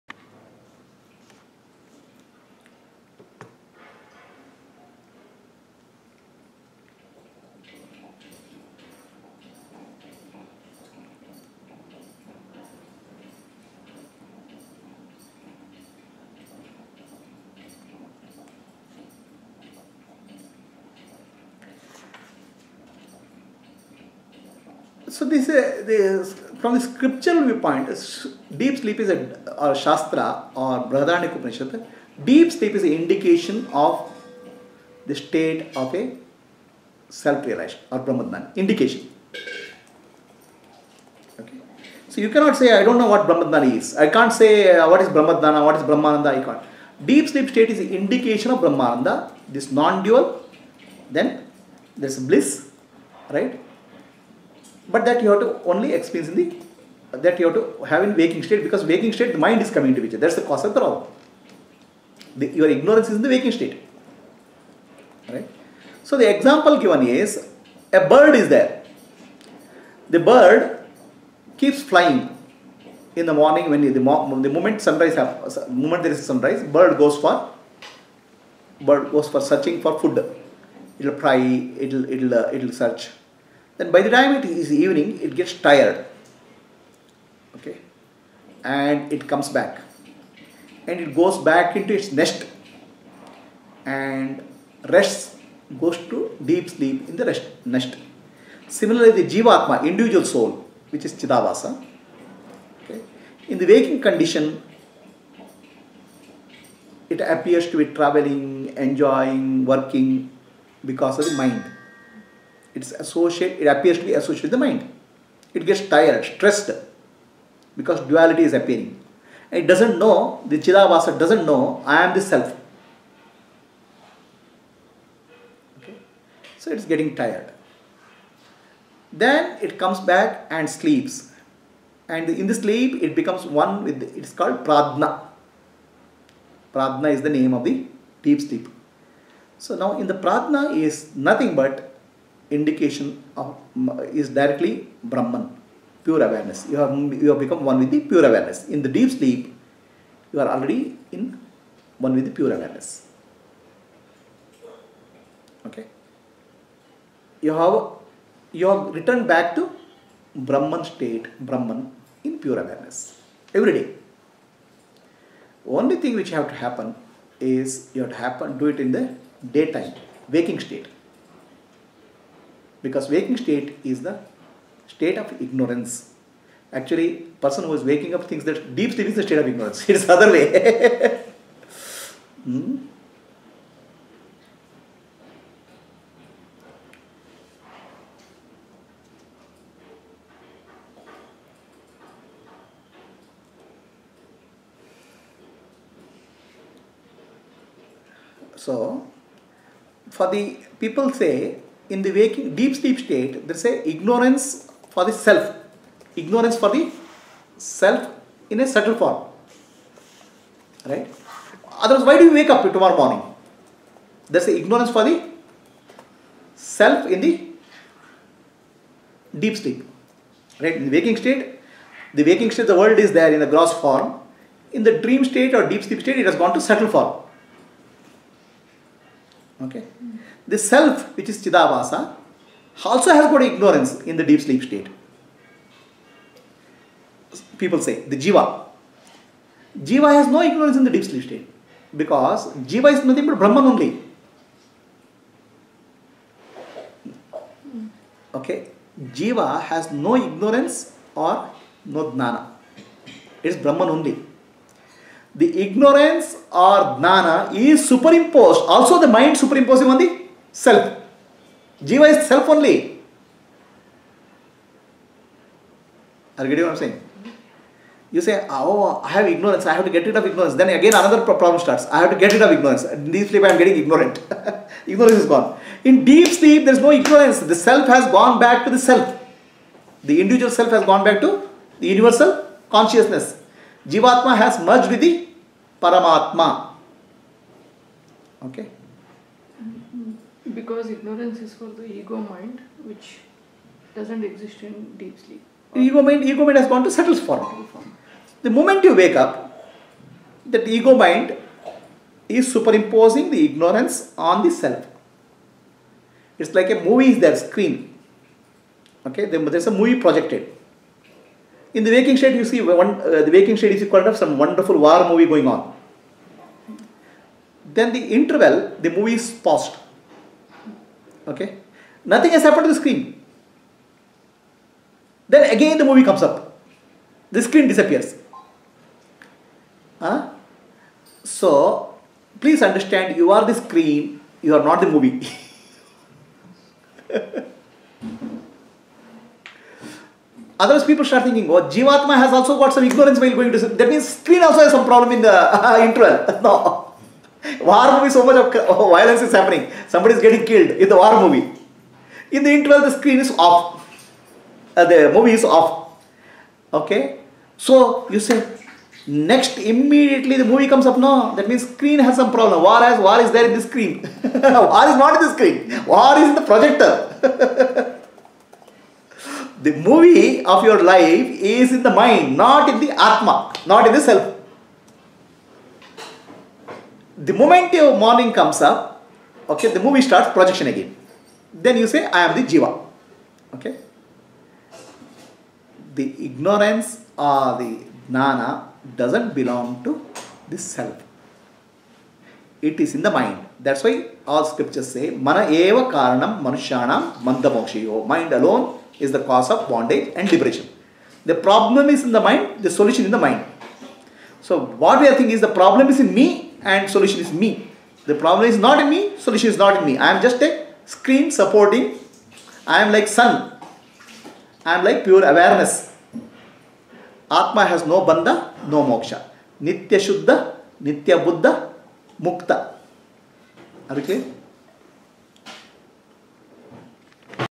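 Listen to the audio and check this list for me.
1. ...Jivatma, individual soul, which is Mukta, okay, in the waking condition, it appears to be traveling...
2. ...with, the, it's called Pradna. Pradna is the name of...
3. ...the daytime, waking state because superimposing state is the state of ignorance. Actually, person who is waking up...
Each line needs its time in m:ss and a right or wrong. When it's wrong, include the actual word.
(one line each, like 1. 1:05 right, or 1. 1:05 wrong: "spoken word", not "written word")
1. 1:39 wrong: "Chidabhasa", not "Mukta"
2. 2:13 right
3. 2:48 wrong: "waking", not "superimposing".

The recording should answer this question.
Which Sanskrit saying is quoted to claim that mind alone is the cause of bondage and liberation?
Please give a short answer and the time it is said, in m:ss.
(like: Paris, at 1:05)
Mana eva karanam manushyanam bandhamokshayoh, at 6:35.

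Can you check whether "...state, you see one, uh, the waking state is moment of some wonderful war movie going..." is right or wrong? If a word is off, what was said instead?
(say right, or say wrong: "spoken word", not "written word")
wrong: "equivalent", not "moment".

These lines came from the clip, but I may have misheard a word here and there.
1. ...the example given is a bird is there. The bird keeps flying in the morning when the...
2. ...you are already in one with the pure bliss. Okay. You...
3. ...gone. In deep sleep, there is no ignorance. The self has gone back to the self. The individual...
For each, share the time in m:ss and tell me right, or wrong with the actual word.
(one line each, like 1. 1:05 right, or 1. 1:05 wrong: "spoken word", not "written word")
1. 1:06 right
2. 2:30 wrong: "awareness", not "bliss"
3. 4:35 right.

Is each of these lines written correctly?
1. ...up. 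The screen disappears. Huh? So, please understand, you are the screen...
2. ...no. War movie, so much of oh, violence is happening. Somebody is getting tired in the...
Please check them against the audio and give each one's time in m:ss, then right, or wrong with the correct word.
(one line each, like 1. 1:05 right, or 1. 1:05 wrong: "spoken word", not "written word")
1. 5:26 right
2. 5:46 wrong: "killed", not "tired".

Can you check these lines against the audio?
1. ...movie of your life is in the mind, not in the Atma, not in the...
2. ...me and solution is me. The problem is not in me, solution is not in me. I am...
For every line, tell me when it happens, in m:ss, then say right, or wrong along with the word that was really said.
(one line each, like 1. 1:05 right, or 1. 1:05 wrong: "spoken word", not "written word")
1. 6:09 right
2. 6:46 right.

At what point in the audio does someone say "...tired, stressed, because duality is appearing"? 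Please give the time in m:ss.
1:55.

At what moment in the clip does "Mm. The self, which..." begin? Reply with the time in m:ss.
3:50.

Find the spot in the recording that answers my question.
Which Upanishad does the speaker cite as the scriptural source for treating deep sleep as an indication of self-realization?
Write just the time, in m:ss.
0:30.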